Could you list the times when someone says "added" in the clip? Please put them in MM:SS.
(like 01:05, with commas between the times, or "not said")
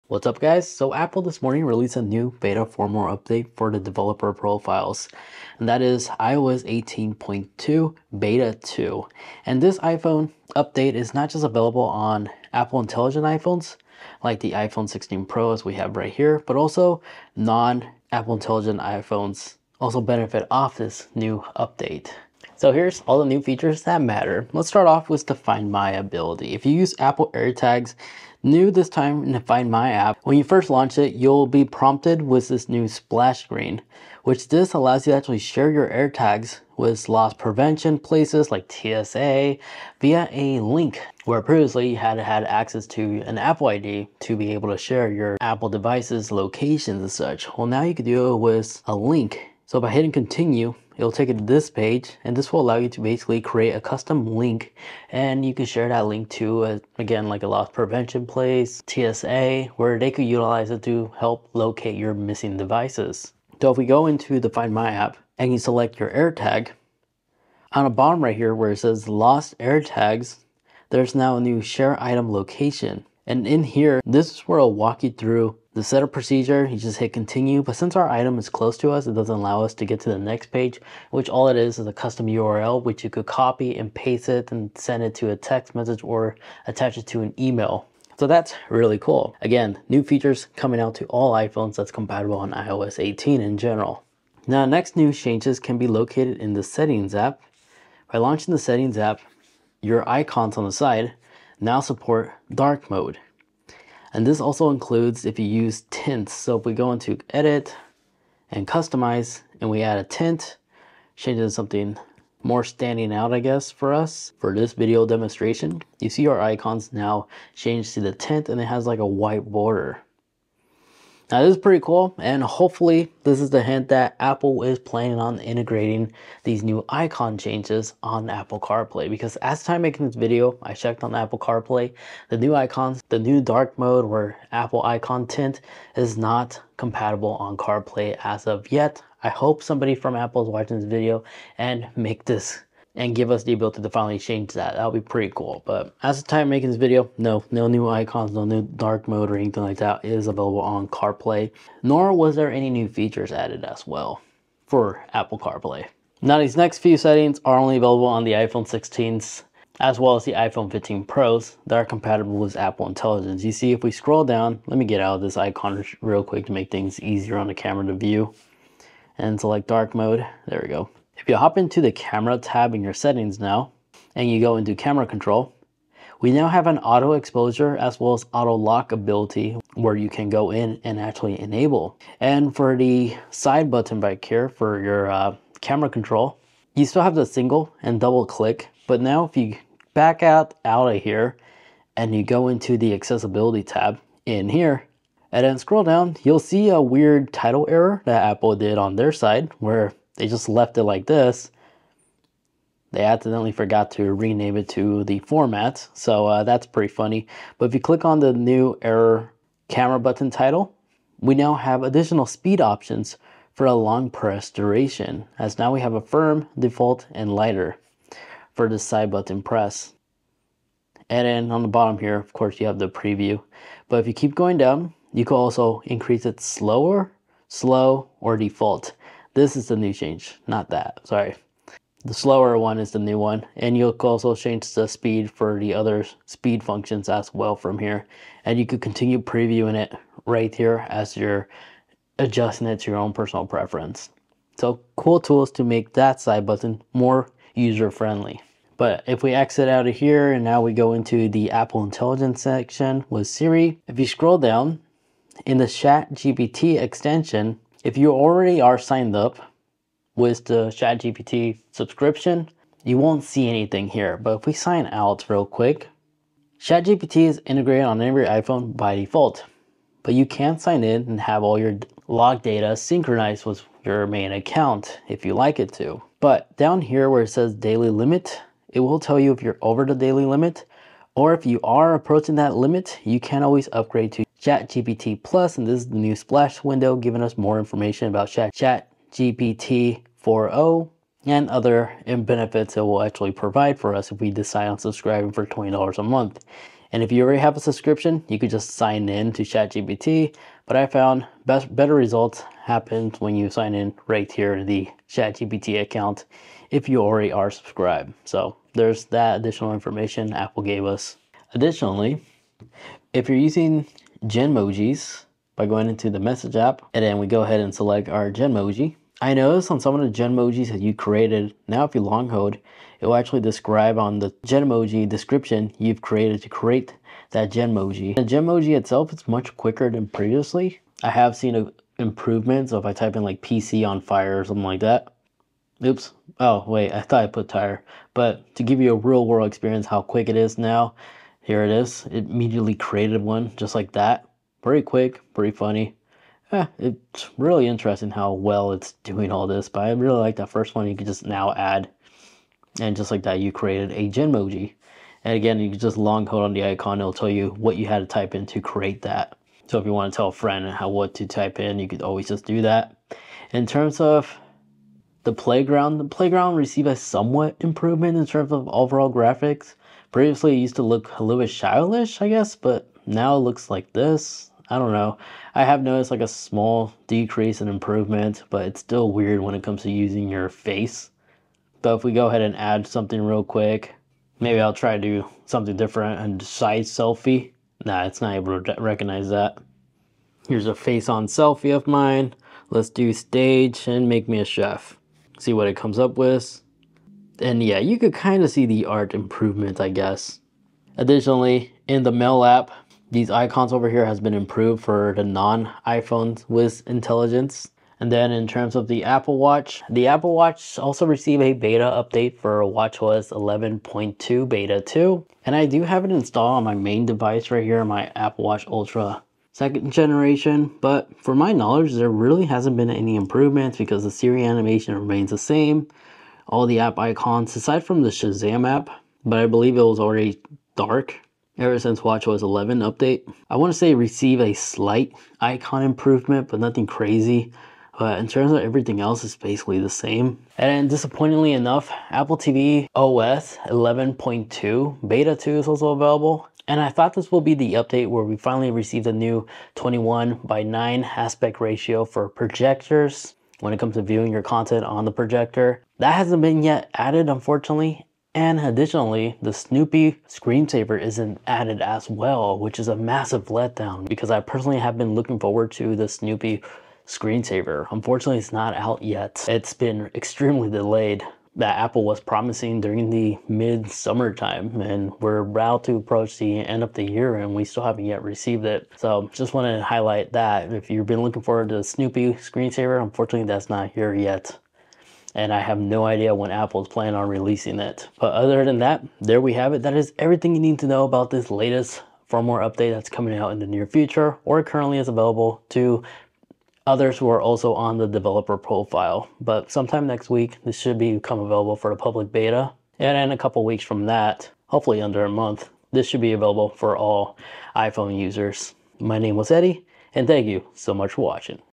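02:33, 07:36, 07:41.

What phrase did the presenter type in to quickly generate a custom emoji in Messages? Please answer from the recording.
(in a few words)
PC on fire.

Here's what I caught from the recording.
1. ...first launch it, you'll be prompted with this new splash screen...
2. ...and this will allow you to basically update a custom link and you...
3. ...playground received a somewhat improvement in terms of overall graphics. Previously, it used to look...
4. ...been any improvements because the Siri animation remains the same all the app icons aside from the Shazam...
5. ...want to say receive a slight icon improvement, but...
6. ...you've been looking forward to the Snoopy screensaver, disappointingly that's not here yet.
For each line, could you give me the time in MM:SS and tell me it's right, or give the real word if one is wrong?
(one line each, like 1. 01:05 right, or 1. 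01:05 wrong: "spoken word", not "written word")
1. 00:30 right
2. 00:52 wrong: "create", not "update"
3. 06:06 right
4. 07:02 right
5. 07:13 right
6. 08:00 wrong: "unfortunately", not "disappointingly".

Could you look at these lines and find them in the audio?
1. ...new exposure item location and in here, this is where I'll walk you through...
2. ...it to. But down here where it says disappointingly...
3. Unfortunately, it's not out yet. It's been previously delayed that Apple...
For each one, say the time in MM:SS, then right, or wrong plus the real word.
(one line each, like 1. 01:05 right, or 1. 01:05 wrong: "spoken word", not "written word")
1. 01:11 wrong: "share", not "exposure"
2. 04:35 wrong: "daily", not "disappointingly"
3. 07:47 wrong: "extremely", not "previously".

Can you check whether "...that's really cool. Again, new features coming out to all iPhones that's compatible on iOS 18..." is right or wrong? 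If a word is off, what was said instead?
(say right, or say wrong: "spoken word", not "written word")
right.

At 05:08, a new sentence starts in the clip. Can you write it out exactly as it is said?
So there's that additional information Apple gave us.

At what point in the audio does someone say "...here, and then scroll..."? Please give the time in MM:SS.
03:14.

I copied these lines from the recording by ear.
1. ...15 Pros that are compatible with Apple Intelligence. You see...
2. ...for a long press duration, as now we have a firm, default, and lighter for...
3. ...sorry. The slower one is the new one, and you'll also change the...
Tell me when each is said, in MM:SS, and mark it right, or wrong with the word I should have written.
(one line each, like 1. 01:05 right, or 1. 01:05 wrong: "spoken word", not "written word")
1. 02:40 right
2. 03:33 right
3. 03:51 right.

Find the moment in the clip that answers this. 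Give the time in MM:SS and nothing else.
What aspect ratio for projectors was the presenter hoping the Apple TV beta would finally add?
07:29.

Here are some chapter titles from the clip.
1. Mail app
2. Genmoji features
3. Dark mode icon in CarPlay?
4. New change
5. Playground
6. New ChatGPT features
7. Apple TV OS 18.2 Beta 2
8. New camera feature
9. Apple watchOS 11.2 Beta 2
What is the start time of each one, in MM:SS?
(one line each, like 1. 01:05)
1. 06:44
2. 05:13
3. 02:07
4. 01:34
5. 06:06
6. 04:04
7. 07:26
8. 02:38
9. 06:56.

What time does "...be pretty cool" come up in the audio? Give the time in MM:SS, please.
02:25.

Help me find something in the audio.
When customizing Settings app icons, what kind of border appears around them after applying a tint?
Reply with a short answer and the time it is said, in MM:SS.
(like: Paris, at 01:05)
white border, at 01:59.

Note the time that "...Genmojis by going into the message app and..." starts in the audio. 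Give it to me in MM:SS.
05:14.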